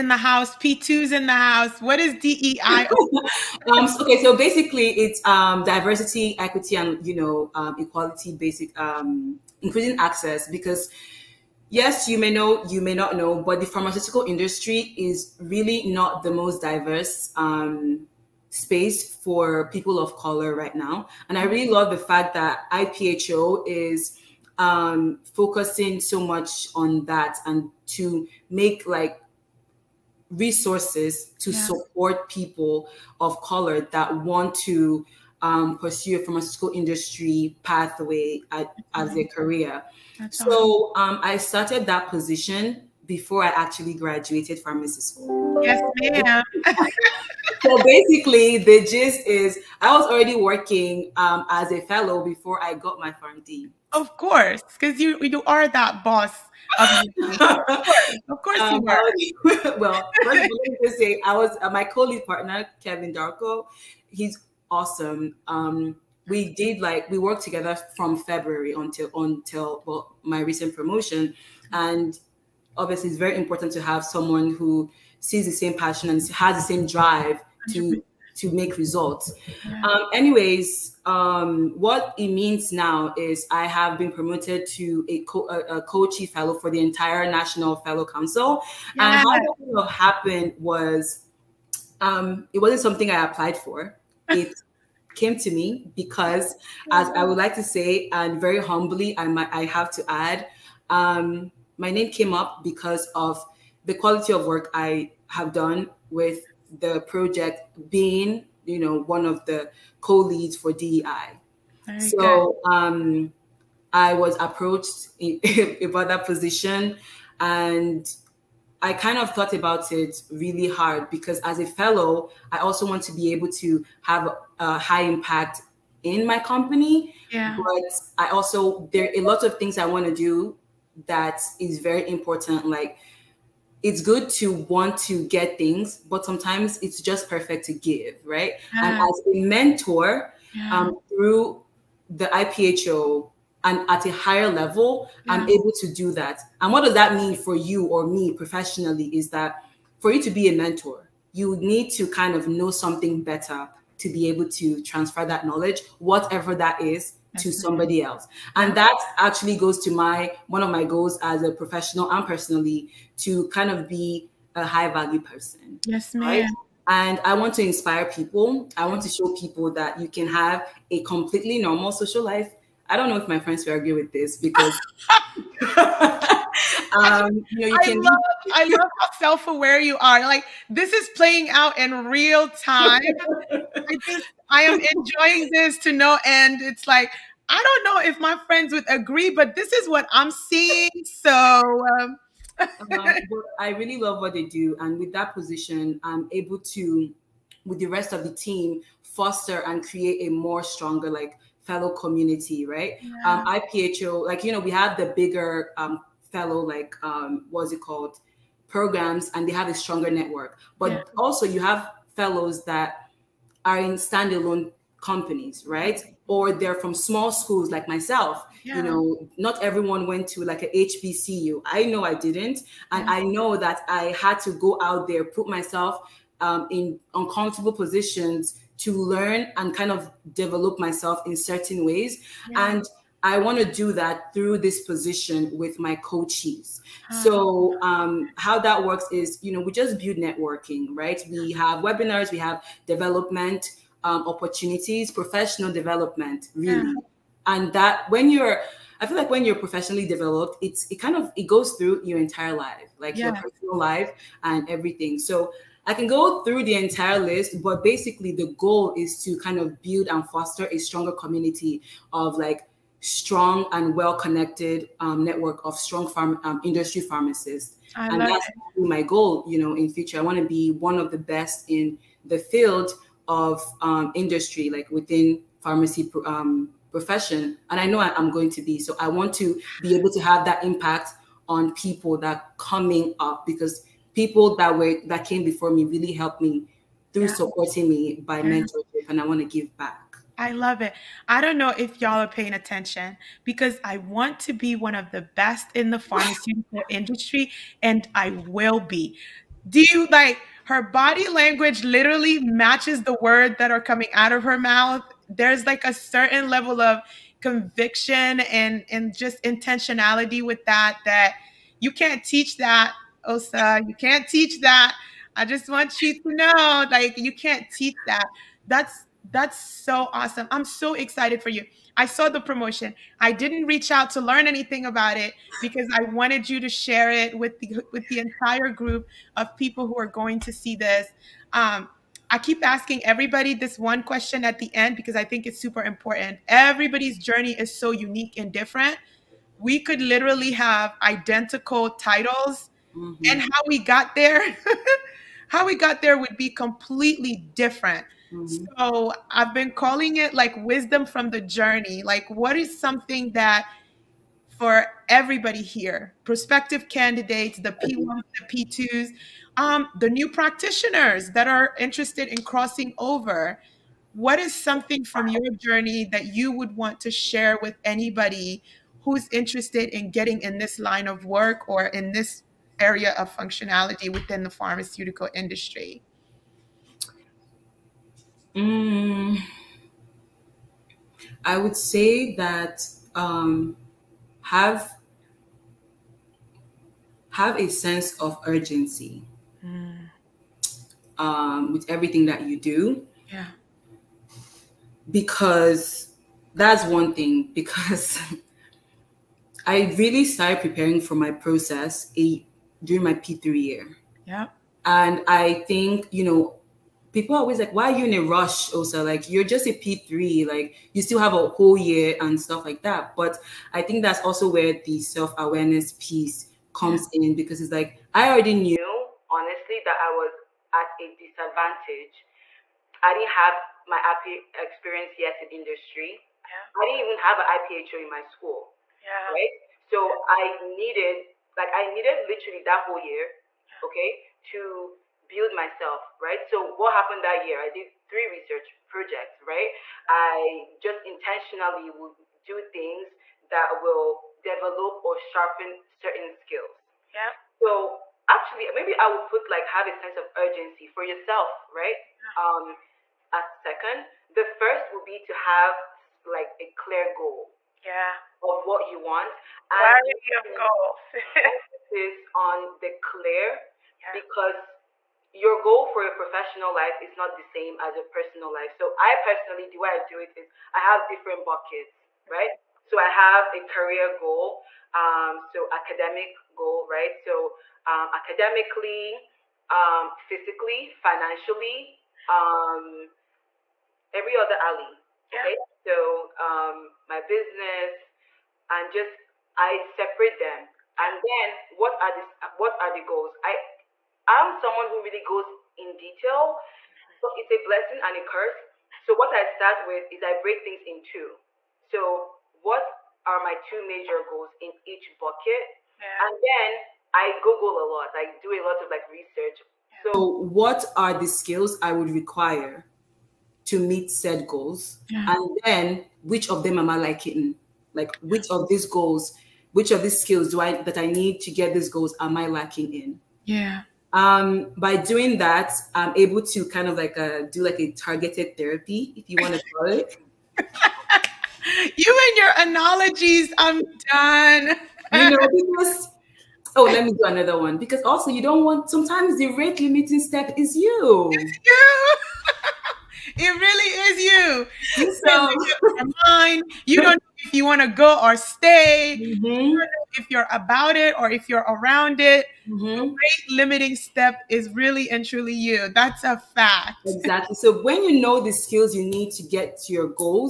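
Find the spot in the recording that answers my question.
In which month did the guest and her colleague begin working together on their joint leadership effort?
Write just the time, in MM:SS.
01:08.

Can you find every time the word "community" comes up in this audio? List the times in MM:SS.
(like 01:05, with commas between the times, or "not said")
03:21, 04:21.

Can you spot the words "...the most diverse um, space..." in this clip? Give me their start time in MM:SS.
00:16.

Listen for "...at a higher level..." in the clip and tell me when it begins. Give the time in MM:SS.
02:23.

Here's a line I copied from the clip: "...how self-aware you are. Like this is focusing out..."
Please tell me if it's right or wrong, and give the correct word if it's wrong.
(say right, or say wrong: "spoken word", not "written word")
wrong: "playing", not "focusing".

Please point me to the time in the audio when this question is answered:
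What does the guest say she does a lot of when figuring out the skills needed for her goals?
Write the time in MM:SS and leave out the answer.
08:27.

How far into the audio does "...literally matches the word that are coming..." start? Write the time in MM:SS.
05:01.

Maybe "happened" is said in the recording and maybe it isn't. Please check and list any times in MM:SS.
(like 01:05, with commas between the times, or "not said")
01:29, 07:16.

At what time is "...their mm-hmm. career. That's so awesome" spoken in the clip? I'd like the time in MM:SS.
00:39.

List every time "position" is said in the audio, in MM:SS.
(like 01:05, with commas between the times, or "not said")
00:42, 01:56, 03:15, 03:47, 03:54.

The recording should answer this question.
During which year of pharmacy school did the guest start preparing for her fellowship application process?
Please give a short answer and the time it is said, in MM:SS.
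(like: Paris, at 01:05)
P3 year, at 06:43.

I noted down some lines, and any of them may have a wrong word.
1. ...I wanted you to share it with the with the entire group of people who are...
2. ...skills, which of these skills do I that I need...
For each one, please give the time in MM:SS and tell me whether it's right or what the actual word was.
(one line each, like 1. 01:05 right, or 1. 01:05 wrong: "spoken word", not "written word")
1. 05:25 right
2. 08:38 wrong: "goals", not "skills".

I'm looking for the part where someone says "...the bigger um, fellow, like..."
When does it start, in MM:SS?
03:24.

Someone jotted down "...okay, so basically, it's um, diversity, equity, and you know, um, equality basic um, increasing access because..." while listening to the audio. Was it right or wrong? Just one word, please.
right.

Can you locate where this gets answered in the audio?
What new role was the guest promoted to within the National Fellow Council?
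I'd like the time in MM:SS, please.
01:25.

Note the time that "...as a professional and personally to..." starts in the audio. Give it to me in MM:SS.
02:41.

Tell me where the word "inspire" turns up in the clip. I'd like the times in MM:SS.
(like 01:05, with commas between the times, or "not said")
02:47.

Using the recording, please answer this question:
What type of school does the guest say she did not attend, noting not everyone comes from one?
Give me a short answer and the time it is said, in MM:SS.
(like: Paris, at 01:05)
HBCU, at 03:40.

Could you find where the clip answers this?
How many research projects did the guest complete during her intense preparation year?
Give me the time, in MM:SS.
07:18.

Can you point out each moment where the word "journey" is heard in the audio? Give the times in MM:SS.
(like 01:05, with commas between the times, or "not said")
05:37, 05:51, 06:05.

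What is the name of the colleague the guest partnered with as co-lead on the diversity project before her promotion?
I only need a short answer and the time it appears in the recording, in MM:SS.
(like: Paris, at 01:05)
Kevin Darko, at 01:02.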